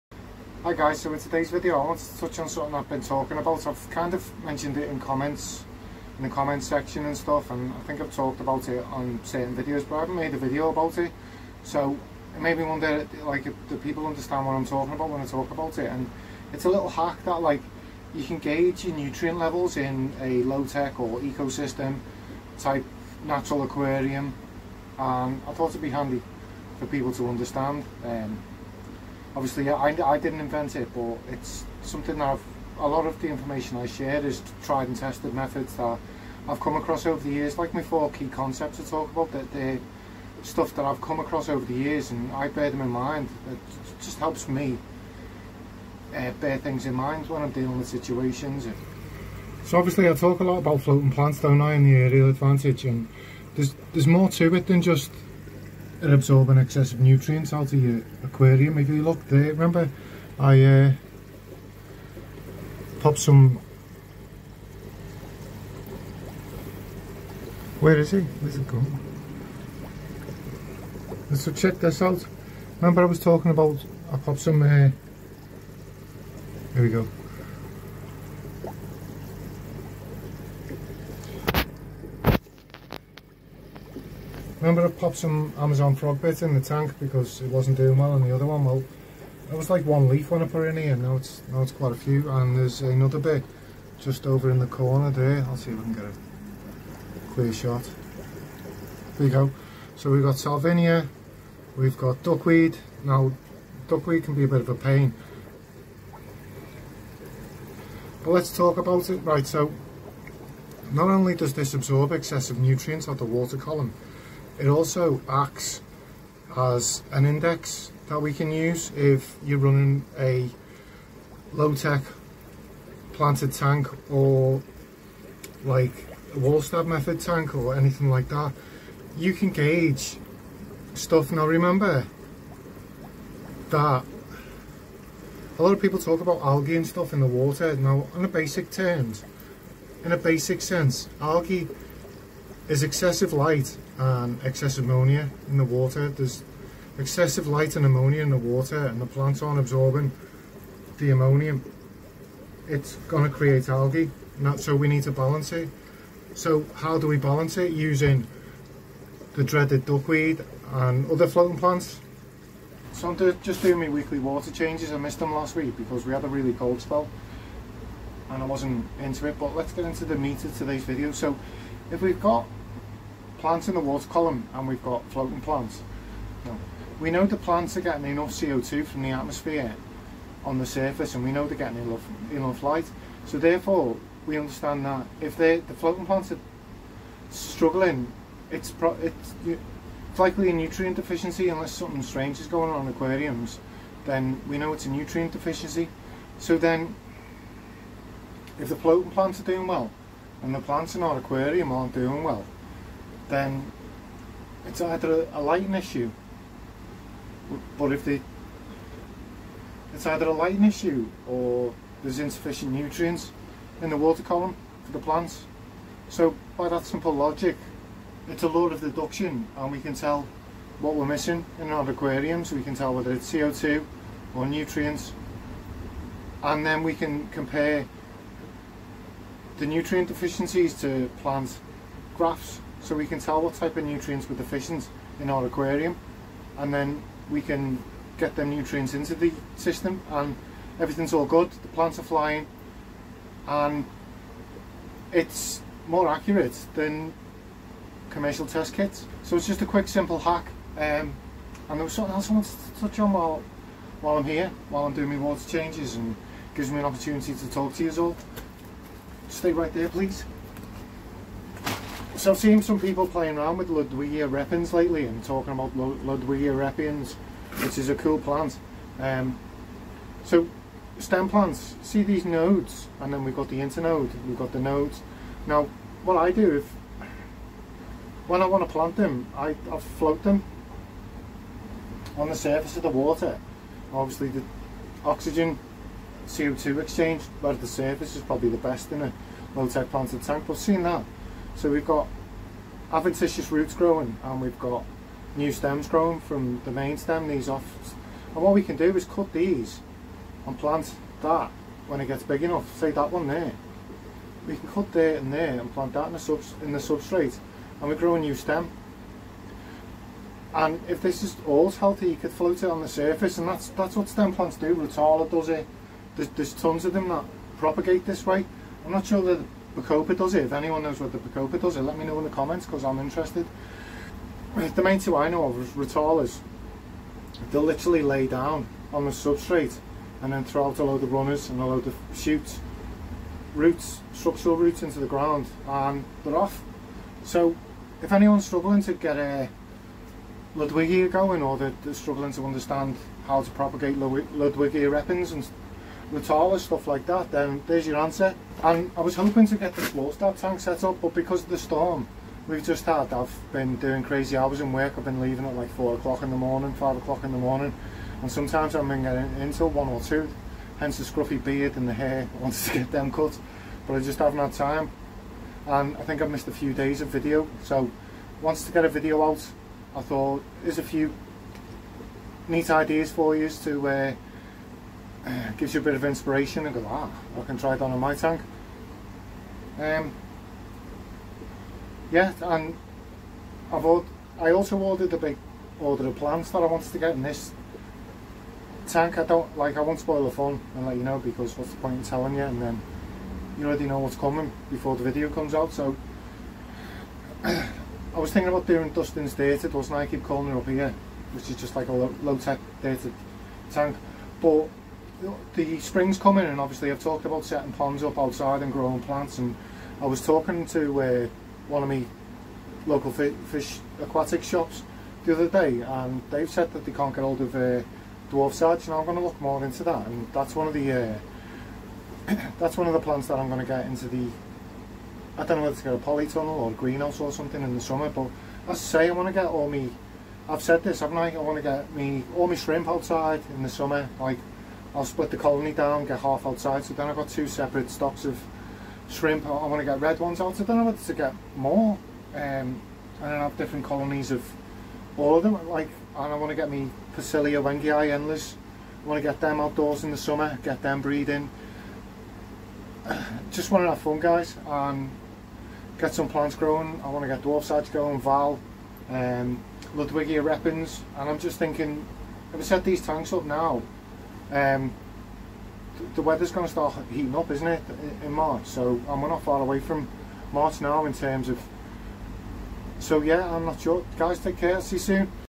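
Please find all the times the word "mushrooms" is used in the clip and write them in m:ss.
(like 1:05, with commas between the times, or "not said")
not said.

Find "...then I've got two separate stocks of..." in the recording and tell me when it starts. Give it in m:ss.
7:16.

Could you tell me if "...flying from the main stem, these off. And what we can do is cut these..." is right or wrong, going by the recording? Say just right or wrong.
wrong.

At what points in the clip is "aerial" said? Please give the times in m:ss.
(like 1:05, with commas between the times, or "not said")
0:51.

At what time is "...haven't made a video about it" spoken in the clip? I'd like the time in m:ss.
0:10.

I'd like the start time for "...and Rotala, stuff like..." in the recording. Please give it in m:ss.
5:45.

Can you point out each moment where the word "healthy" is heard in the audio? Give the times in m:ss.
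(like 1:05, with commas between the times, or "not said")
5:11.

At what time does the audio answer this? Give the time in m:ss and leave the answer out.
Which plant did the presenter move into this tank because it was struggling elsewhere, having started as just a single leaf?
1:25.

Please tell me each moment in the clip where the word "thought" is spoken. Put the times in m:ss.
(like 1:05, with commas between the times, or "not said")
0:25, 6:10.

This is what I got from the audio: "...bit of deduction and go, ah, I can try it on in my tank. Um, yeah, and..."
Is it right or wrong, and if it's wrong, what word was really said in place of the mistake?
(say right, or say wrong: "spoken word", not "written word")
wrong: "inspiration", not "deduction".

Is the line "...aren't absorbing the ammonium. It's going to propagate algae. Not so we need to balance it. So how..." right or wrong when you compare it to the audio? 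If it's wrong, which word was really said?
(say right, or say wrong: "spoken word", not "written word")
wrong: "create", not "propagate".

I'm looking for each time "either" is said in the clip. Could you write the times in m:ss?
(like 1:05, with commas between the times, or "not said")
3:24, 3:30.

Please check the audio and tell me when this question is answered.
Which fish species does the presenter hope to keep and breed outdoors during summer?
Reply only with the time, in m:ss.
7:27.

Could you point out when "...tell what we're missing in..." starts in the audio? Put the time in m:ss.
3:39.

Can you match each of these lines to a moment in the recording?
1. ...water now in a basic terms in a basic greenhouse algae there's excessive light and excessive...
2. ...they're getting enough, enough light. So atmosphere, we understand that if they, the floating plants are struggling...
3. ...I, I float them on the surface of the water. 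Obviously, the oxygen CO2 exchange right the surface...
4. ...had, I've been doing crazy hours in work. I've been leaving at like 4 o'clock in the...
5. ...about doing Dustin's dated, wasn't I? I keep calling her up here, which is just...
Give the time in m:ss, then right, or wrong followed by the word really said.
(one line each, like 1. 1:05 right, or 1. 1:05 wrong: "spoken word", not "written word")
1. 2:17 wrong: "sense", not "greenhouse"
2. 3:01 wrong: "therefore", not "atmosphere"
3. 4:39 right
4. 5:52 right
5. 6:38 right.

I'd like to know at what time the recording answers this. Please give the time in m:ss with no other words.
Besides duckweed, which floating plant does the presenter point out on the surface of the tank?
1:40.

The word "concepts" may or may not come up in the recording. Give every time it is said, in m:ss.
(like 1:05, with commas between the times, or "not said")
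0:38.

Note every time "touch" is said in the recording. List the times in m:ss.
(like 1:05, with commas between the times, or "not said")
0:02, 4:12.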